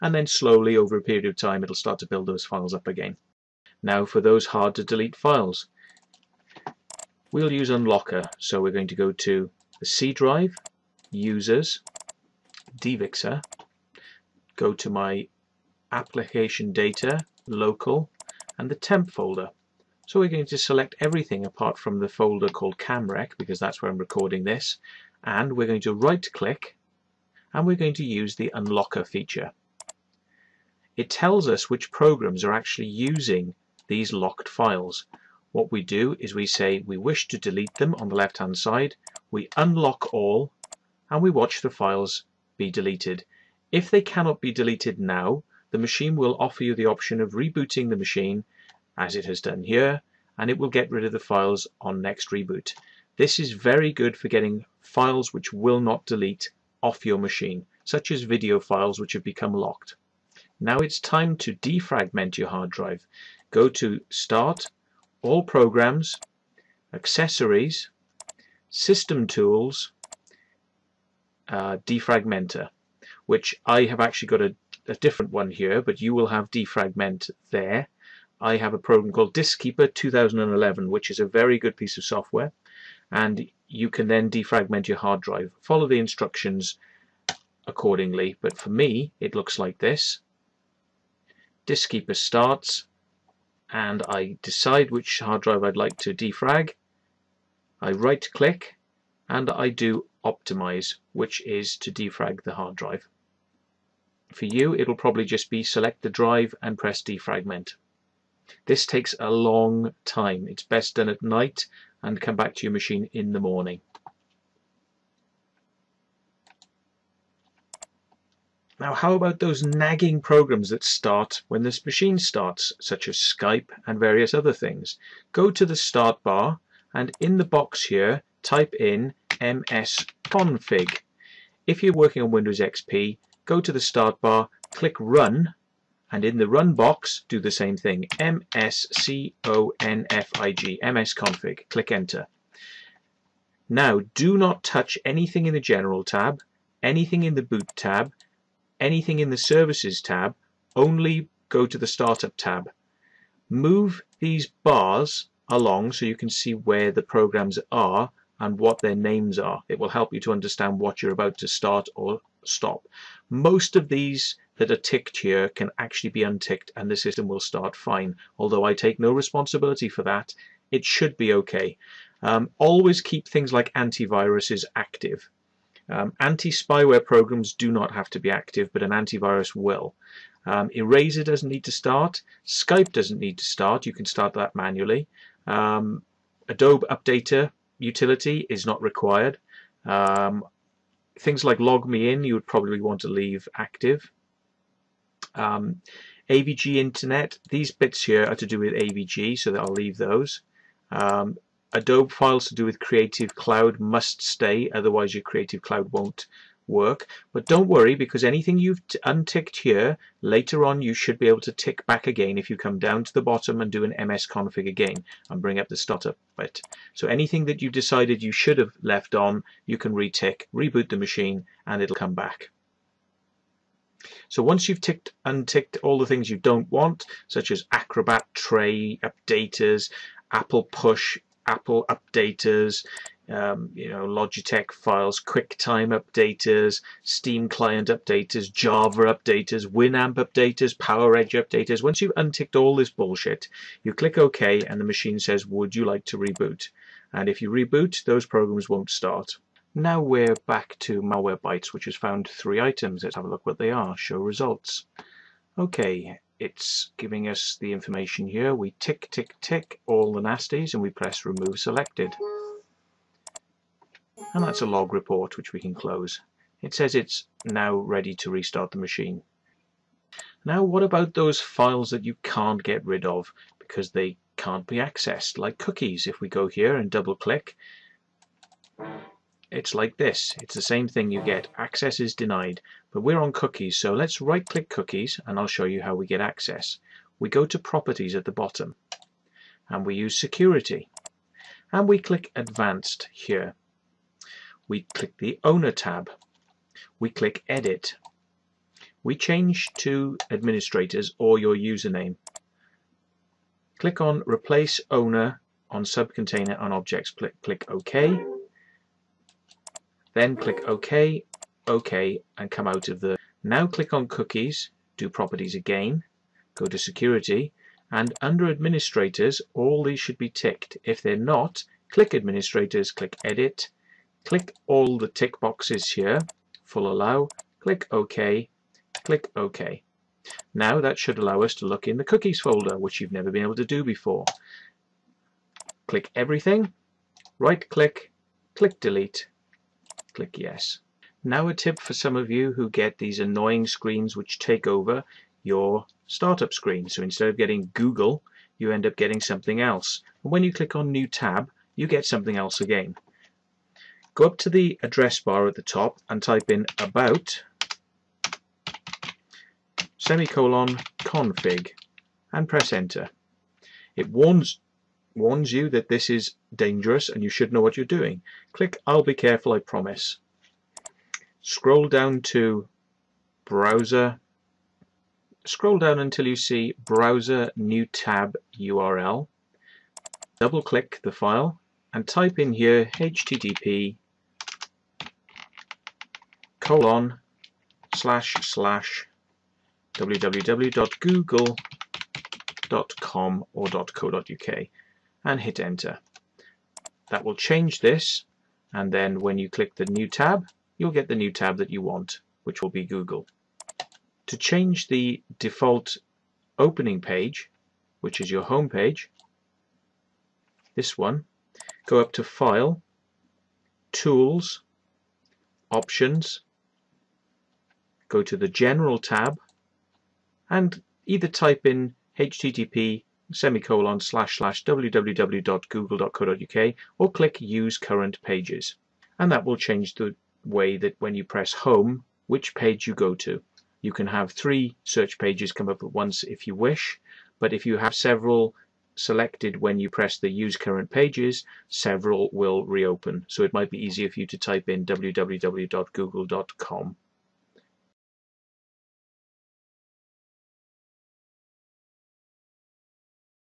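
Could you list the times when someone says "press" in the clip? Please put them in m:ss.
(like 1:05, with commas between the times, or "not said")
1:46, 4:20, 6:02, 7:11, 7:19.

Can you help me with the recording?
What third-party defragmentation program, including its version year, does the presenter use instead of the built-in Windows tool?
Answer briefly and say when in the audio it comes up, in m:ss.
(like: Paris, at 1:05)
Diskeeper 2011, at 1:19.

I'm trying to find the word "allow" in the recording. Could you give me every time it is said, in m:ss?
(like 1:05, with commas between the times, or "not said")
5:26, 5:31.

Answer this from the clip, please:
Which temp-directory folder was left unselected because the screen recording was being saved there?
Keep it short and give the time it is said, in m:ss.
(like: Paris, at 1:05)
CamRec, at 0:22.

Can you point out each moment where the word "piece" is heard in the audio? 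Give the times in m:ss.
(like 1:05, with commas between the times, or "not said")
1:21.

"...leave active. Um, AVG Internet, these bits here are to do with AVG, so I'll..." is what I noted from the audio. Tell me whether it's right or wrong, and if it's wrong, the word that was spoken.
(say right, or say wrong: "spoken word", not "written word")
right.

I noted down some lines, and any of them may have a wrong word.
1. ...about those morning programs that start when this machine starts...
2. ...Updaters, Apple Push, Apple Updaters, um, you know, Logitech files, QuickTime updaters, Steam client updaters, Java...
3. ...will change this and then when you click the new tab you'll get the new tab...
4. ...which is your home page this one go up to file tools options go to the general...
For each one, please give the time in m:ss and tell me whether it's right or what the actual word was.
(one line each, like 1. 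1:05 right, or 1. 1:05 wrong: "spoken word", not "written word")
1. 1:59 wrong: "nagging", not "morning"
2. 3:49 right
3. 6:37 right
4. 6:47 right.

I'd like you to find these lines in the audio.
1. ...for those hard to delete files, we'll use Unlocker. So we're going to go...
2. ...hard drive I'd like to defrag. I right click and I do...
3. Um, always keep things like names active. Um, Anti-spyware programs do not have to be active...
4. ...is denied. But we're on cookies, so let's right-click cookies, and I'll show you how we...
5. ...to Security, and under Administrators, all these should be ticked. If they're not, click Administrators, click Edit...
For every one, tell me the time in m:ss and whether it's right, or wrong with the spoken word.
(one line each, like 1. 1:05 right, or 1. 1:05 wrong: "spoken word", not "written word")
1. 0:04 right
2. 1:35 right
3. 2:52 wrong: "antiviruses", not "names"
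4. 4:41 right
5. 5:16 right.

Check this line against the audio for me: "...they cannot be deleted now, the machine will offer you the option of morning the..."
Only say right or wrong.
wrong.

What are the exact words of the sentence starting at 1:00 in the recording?
Now it's time to defragment your hard drive.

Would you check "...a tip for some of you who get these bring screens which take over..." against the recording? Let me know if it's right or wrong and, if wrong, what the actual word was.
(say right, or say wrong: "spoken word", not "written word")
wrong: "annoying", not "bring".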